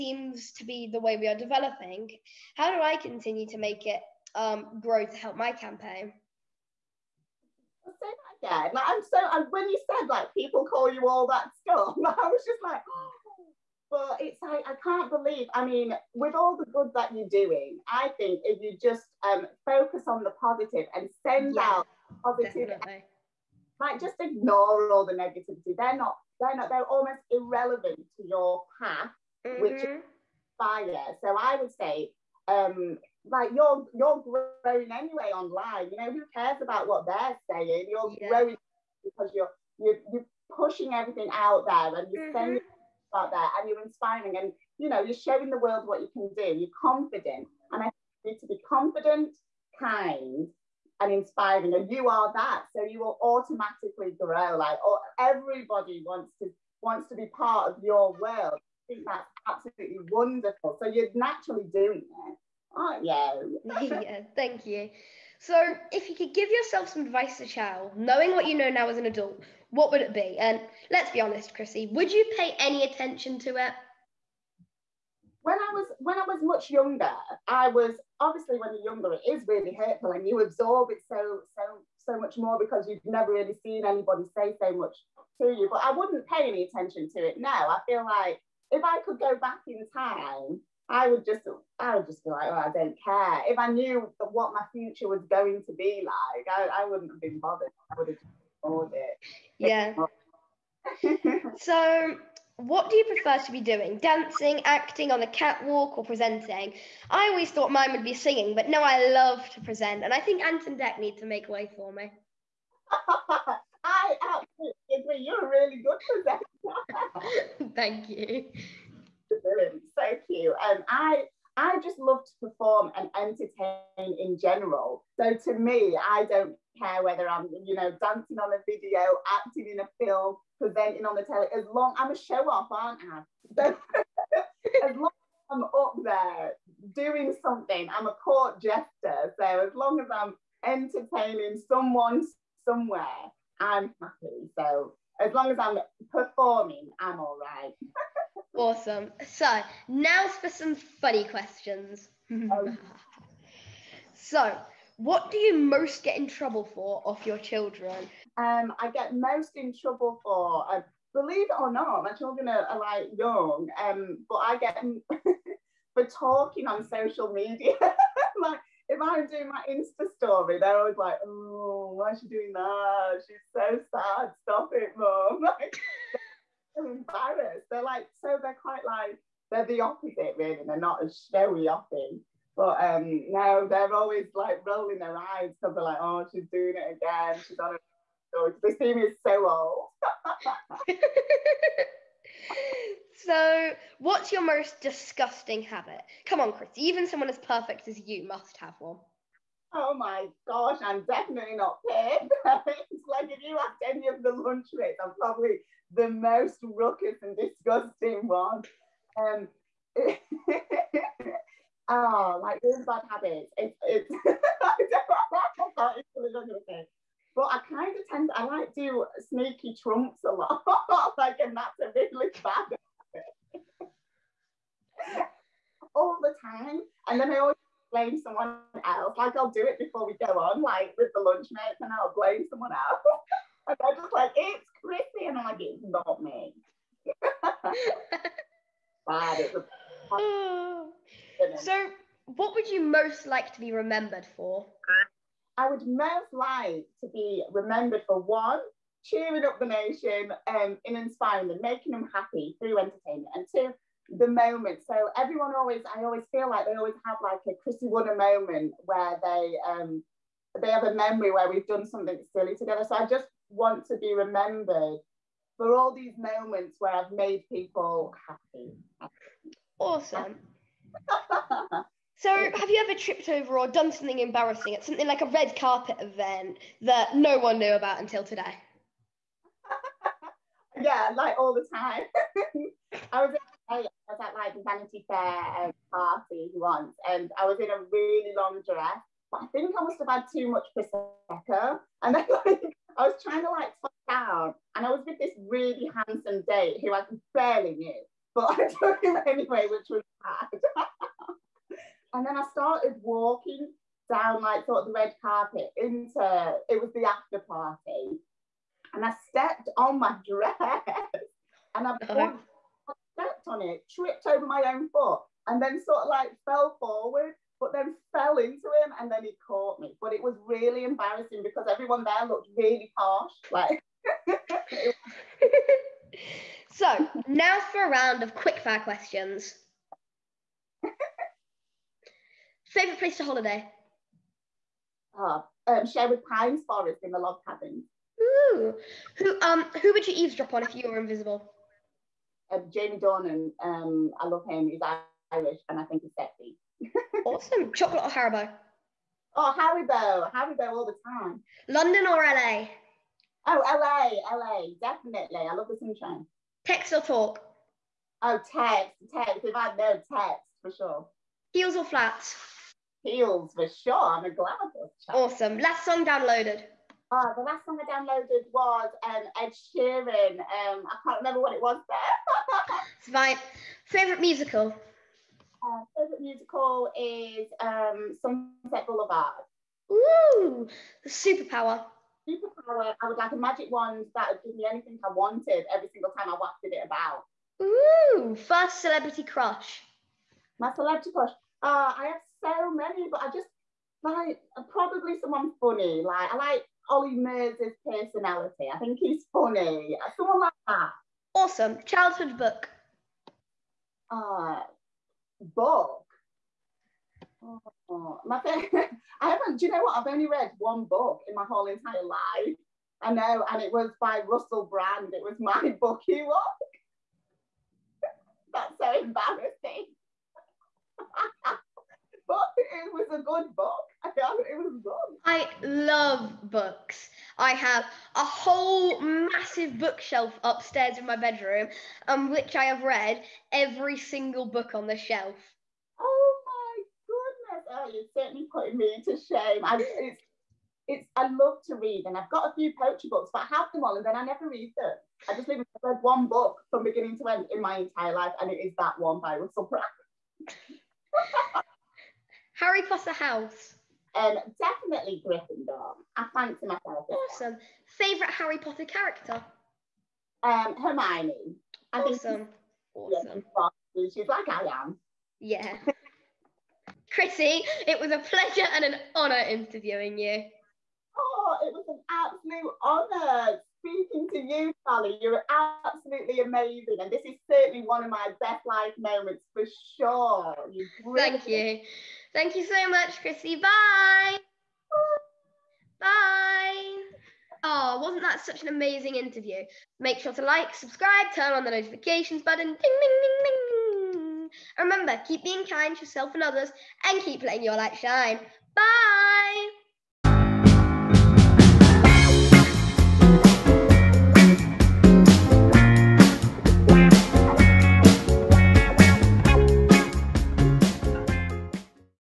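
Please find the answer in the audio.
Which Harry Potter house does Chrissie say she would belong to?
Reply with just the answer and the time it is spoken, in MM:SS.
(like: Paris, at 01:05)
Gryffindor, at 07:35.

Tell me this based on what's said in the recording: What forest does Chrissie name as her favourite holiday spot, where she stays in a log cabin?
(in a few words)
Sherwood Pines Forest.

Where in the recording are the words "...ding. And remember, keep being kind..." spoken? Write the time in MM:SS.
08:13.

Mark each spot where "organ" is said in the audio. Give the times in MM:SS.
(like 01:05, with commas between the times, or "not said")
not said.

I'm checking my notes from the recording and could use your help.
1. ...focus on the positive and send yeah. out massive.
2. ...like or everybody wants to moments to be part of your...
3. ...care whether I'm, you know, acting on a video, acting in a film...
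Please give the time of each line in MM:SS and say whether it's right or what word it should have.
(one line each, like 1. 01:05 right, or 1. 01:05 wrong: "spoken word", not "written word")
1. 00:19 wrong: "positive", not "massive"
2. 00:54 wrong: "wants", not "moments"
3. 02:06 wrong: "dancing", not "acting".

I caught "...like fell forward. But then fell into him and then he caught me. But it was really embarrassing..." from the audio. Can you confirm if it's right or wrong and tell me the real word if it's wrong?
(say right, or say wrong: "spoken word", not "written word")
right.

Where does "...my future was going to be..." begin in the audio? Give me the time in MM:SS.
01:34.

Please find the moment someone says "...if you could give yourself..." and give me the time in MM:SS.
01:05.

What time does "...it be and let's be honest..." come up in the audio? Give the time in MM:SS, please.
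01:10.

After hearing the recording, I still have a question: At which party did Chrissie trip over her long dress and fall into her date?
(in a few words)
Vanity Fair.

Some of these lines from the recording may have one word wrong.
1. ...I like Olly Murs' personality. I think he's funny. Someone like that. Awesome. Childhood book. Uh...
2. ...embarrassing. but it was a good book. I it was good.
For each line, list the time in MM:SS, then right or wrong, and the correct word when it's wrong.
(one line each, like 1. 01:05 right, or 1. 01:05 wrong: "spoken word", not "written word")
1. 06:36 right
2. 06:59 right.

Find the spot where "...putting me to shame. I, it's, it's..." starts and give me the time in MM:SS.
07:18.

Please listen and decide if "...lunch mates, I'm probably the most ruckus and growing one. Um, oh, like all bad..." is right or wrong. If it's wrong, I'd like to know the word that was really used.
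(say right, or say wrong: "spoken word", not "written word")
wrong: "disgusting", not "growing".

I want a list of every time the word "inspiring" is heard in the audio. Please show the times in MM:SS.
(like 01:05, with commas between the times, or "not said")
00:43, 00:51, 04:10.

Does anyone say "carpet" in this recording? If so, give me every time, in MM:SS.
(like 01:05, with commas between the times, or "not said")
04:35, 05:05.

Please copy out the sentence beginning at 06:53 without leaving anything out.
I know, and it was by Russell Brand.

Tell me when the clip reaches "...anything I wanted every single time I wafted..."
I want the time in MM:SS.
06:24.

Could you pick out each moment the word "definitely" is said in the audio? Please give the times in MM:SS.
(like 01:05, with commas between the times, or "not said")
03:21, 05:54, 07:34.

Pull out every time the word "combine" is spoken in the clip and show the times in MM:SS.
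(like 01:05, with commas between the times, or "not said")
not said.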